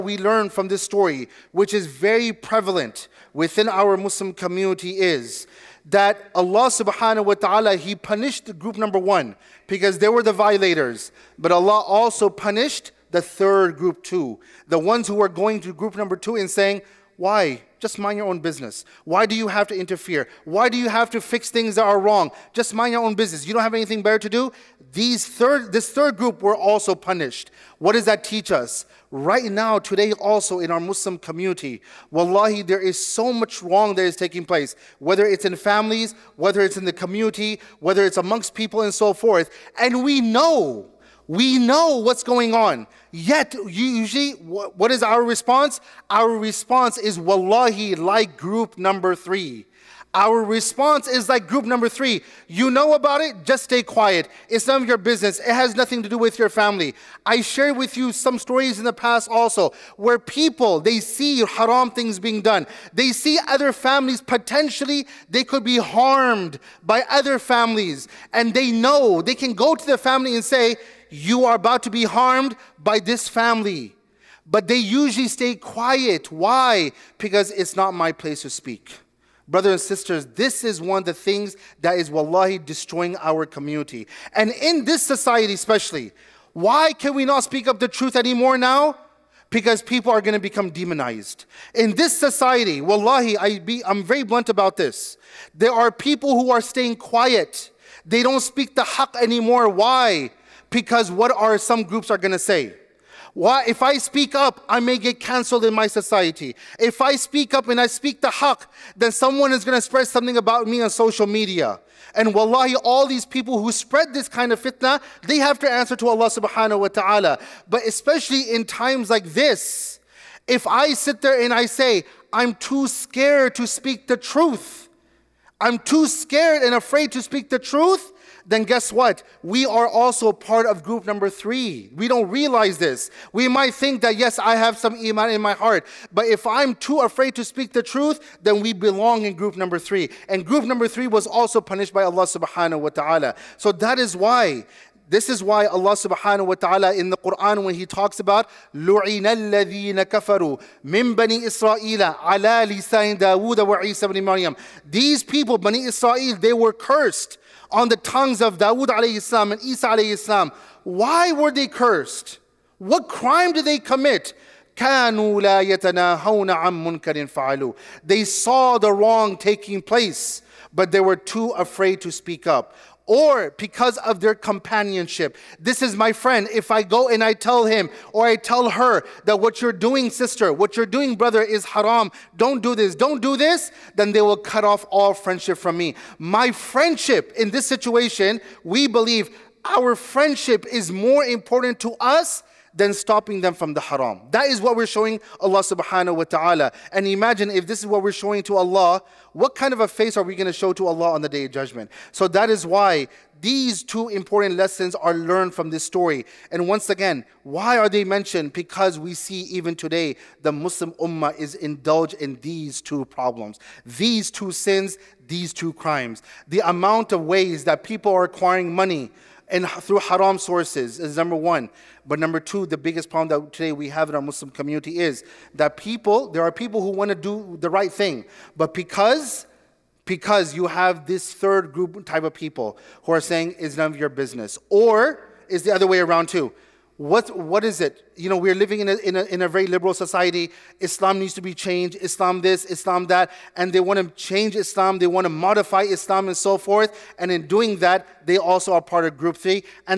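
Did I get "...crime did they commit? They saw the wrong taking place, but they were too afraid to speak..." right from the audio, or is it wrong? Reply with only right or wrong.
right.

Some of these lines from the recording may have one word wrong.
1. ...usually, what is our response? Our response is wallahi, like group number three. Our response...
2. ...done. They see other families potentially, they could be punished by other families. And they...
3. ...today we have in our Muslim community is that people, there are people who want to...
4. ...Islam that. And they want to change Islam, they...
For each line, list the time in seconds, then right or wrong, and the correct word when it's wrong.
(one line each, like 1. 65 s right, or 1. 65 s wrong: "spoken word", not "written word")
1. 43 s right
2. 62 s wrong: "harmed", not "punished"
3. 223 s right
4. 242 s right.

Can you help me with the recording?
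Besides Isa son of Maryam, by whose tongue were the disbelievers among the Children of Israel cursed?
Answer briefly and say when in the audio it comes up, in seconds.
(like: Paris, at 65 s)
Dawood, at 153 s.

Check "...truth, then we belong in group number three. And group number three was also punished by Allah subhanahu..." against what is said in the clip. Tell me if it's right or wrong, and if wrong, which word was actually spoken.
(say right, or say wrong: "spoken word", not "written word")
right.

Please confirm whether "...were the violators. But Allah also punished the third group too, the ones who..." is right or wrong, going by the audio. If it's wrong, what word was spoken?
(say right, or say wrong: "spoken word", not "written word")
right.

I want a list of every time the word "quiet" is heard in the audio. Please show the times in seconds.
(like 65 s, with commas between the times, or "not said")
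53 s, 75 s, 96 s.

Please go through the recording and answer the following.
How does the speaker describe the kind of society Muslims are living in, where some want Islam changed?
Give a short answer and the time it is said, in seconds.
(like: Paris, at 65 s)
very liberal, at 239 s.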